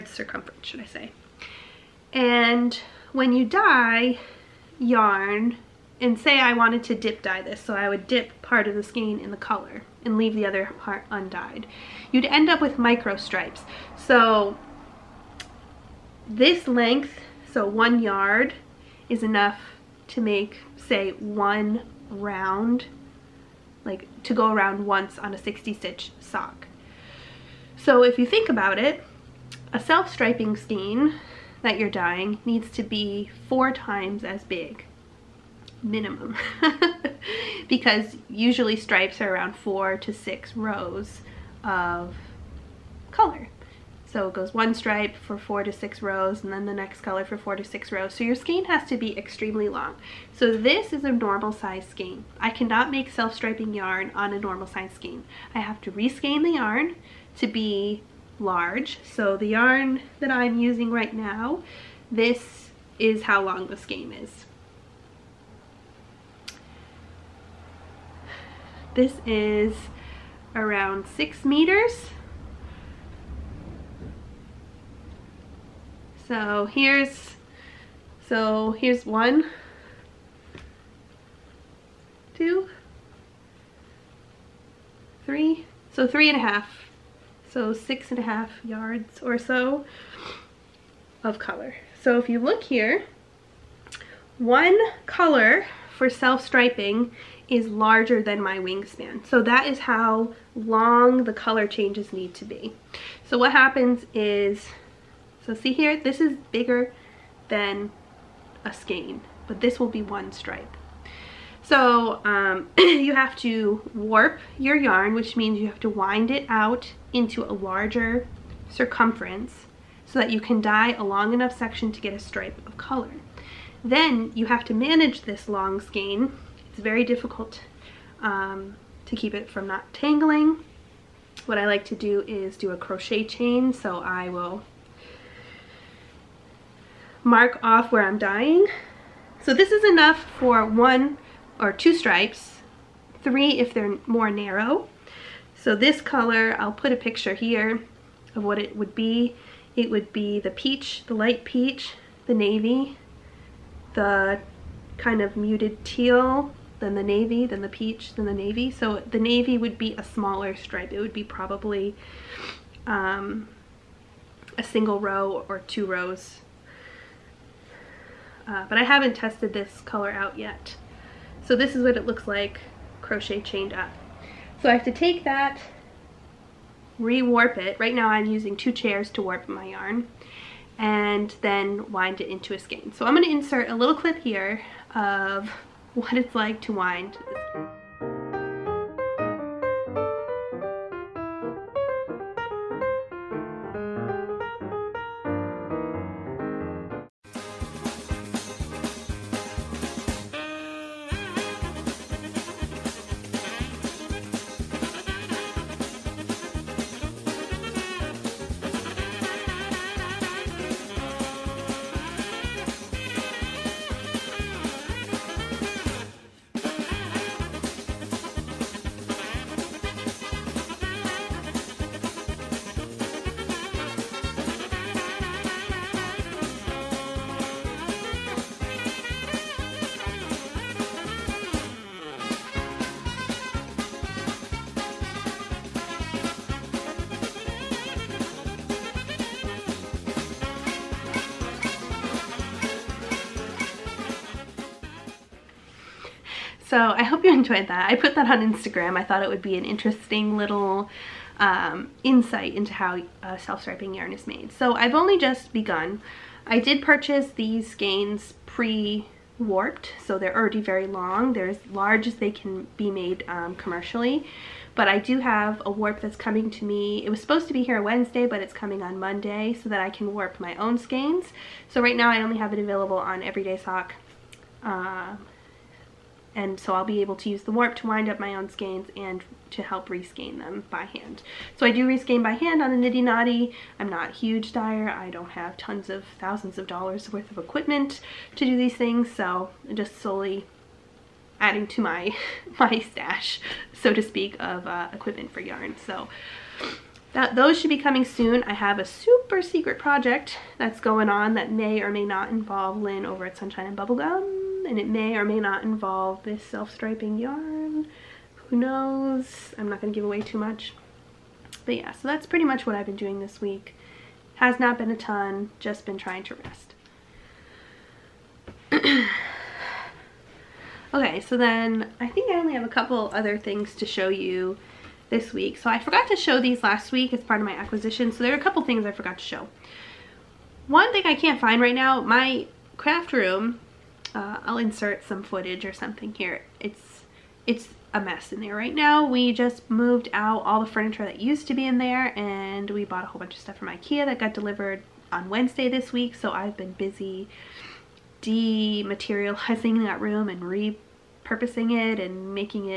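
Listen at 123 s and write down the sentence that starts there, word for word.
Then you have to manage this long skein.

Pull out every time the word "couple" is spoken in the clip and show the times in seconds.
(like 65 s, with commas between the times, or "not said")
322 s, 328 s.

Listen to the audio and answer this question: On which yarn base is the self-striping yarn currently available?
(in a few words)
Everyday Sock.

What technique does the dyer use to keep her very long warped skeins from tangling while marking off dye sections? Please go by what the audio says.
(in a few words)
Crochet chain.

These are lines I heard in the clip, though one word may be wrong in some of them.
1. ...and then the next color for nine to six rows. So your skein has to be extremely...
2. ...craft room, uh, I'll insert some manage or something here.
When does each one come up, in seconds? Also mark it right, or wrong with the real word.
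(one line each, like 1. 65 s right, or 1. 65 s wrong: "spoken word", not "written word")
1. 46 s wrong: "four", not "nine"
2. 332 s wrong: "footage", not "manage".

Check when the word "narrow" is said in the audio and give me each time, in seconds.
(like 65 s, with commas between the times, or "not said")
144 s.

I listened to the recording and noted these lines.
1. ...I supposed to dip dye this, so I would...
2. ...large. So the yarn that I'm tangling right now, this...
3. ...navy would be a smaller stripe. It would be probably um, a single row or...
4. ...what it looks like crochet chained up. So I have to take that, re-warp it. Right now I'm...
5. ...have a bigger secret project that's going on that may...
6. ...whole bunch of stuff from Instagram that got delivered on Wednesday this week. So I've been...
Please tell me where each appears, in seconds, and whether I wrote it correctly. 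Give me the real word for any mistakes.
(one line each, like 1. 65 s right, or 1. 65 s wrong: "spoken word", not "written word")
1. 6 s wrong: "wanted", not "supposed"
2. 58 s wrong: "using", not "tangling"
3. 159 s right
4. 171 s right
5. 298 s wrong: "super", not "bigger"
6. 343 s wrong: "Ikea", not "Instagram".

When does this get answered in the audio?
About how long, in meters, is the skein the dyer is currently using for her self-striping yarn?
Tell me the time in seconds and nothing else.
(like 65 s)
70 s.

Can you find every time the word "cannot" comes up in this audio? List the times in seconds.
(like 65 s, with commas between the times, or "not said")
52 s.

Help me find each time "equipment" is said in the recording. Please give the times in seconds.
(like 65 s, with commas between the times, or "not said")
287 s, 294 s.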